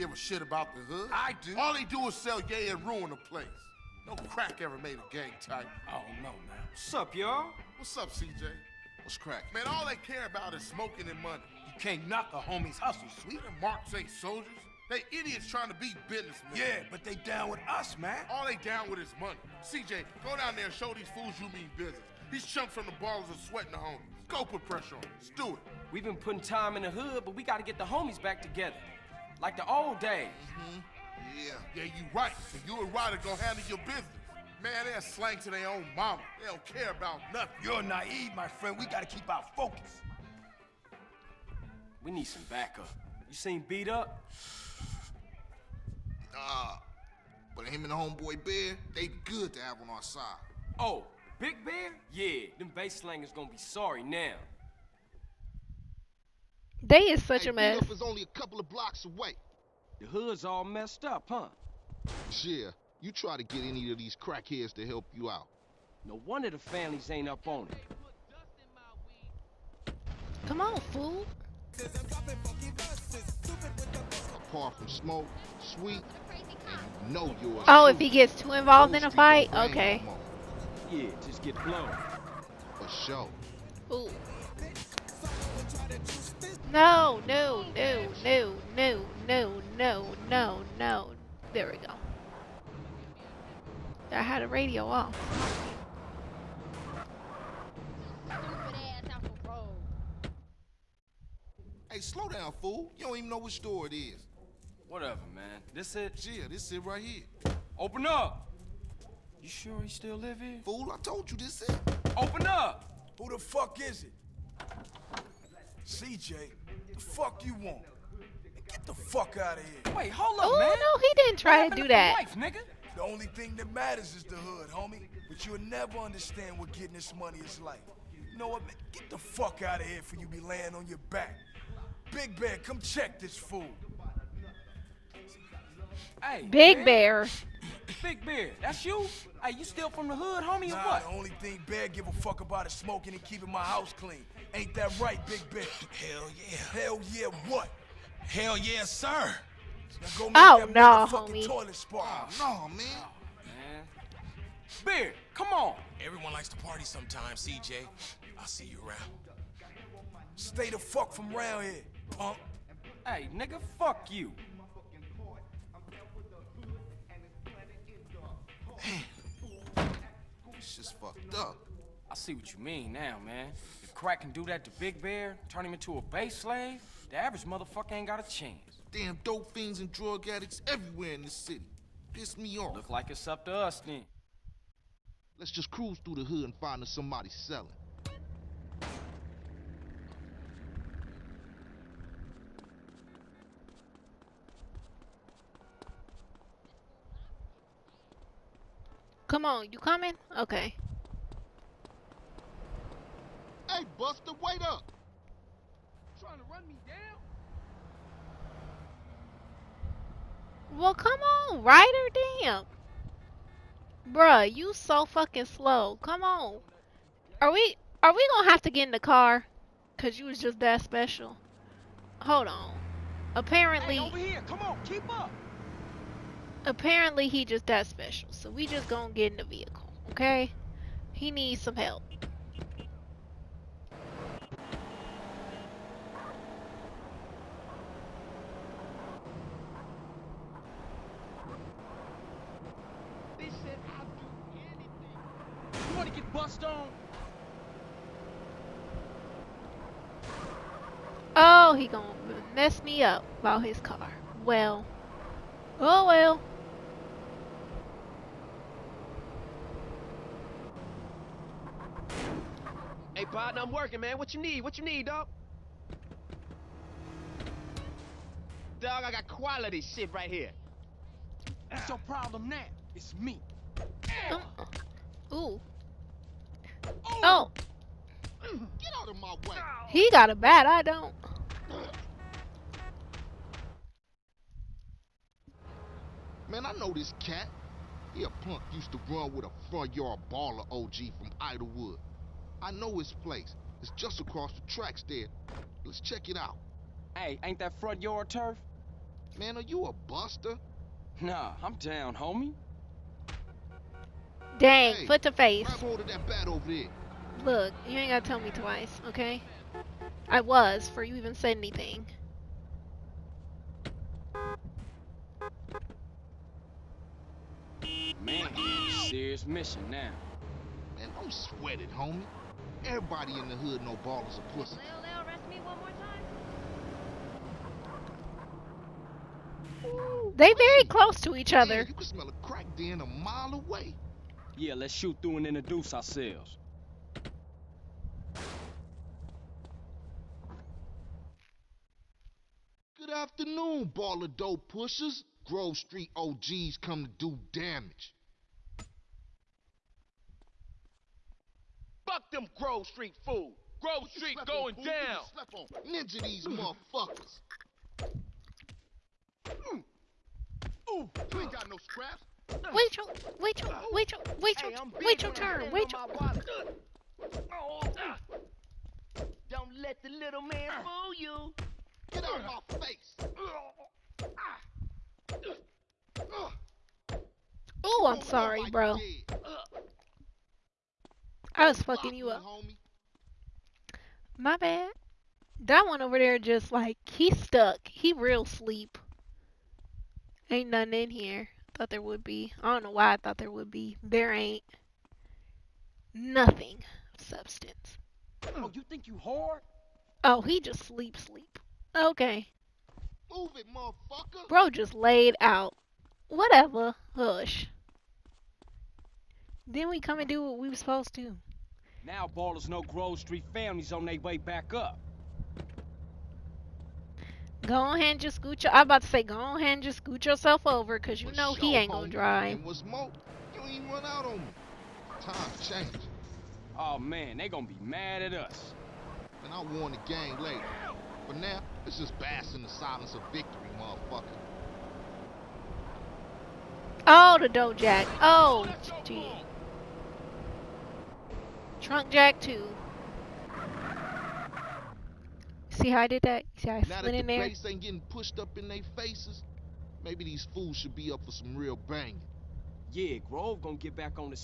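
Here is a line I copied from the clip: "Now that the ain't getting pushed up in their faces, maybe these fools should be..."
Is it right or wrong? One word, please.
right.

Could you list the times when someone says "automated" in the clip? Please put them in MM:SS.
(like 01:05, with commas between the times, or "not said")
not said.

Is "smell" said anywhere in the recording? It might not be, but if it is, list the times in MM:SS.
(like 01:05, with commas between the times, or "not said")
05:32.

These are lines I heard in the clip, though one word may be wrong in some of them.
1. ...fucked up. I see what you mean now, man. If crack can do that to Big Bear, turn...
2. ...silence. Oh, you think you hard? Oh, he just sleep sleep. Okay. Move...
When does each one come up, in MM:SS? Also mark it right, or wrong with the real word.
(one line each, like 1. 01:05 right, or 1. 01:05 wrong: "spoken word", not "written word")
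1. 02:51 right
2. 06:37 wrong: "substance", not "silence".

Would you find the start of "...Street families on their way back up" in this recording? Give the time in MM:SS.
06:53.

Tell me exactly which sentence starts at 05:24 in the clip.
Well, they'll arrest me one more time.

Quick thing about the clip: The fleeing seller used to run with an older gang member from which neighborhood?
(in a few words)
Idlewood.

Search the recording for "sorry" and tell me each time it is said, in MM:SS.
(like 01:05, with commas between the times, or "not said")
00:53, 06:18.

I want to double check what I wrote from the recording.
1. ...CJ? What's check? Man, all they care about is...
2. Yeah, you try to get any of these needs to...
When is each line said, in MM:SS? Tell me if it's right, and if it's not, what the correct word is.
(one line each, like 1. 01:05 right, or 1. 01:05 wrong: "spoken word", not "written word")
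1. 00:08 wrong: "crack", not "check"
2. 01:02 wrong: "crackheads", not "needs".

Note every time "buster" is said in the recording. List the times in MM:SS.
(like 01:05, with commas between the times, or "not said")
03:23, 05:00.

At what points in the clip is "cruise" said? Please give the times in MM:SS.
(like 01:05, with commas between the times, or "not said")
03:05.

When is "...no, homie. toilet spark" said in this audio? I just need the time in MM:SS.
02:30.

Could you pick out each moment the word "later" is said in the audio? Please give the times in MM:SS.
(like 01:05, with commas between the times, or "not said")
07:10.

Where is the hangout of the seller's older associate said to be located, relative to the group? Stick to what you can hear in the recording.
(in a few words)
across the tracks.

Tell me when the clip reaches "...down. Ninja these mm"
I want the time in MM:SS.
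05:54.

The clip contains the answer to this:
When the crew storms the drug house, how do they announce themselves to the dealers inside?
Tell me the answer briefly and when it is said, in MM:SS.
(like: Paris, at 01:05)
Grove Street OGs, at 05:45.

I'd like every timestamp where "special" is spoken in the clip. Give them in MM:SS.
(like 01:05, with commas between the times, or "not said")
03:40, 03:47.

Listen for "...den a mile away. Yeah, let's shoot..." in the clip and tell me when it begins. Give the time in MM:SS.
05:32.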